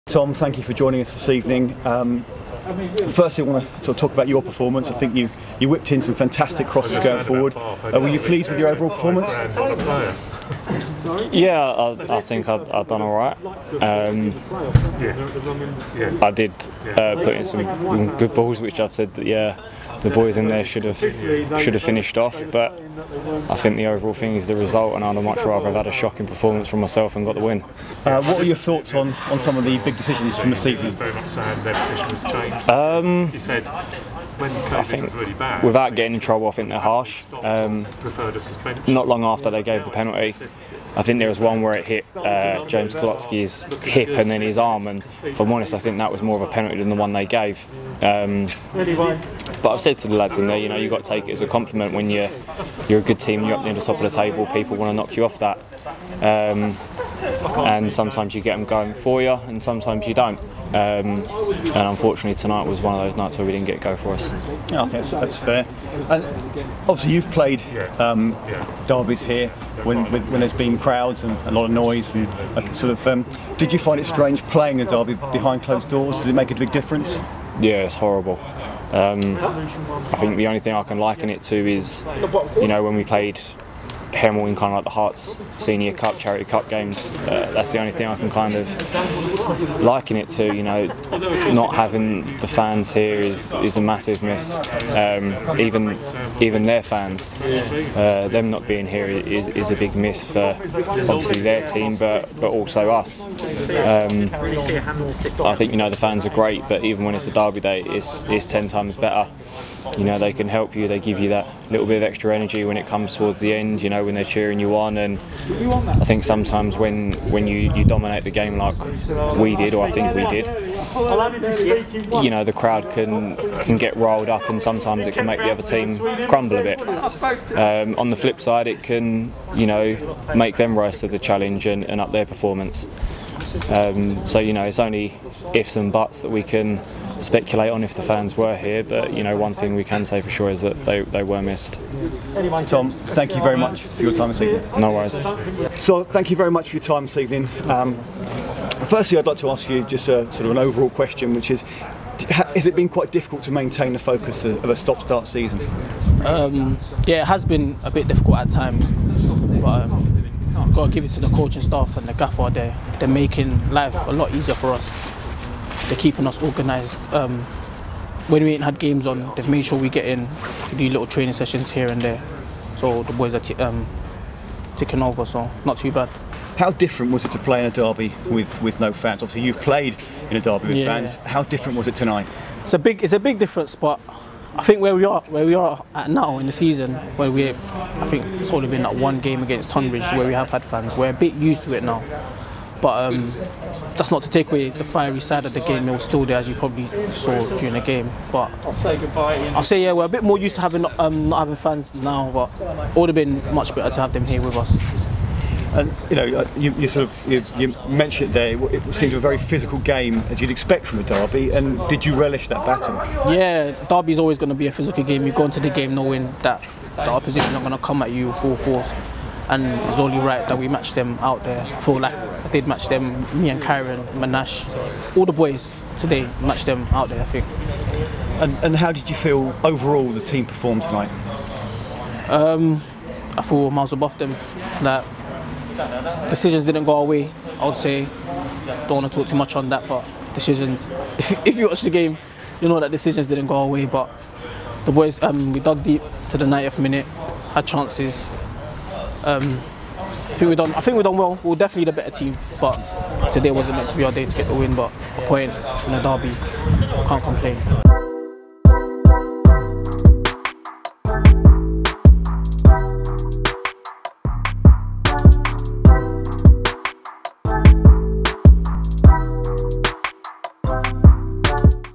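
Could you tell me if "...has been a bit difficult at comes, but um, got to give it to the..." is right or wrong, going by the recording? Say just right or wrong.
wrong.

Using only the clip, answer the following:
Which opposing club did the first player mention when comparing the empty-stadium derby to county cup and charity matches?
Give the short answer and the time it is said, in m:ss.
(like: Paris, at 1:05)
Hemel, at 1:24.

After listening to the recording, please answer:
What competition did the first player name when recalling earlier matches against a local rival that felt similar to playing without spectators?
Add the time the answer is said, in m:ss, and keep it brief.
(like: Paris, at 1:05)
Herts Senior Cup, at 1:24.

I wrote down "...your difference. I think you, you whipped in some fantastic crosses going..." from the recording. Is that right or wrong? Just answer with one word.
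wrong.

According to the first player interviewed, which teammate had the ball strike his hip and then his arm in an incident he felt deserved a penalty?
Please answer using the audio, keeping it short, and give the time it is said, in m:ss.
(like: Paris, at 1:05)
James Kolotsky, at 0:42.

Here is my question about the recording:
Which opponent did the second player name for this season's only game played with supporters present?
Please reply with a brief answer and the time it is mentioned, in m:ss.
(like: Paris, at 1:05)
Tonbridge, at 3:09.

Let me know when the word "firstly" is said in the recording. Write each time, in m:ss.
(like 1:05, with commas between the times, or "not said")
0:03, 2:28.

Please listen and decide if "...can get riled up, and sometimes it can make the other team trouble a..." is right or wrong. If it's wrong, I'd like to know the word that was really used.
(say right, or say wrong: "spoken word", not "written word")
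wrong: "crumble", not "trouble".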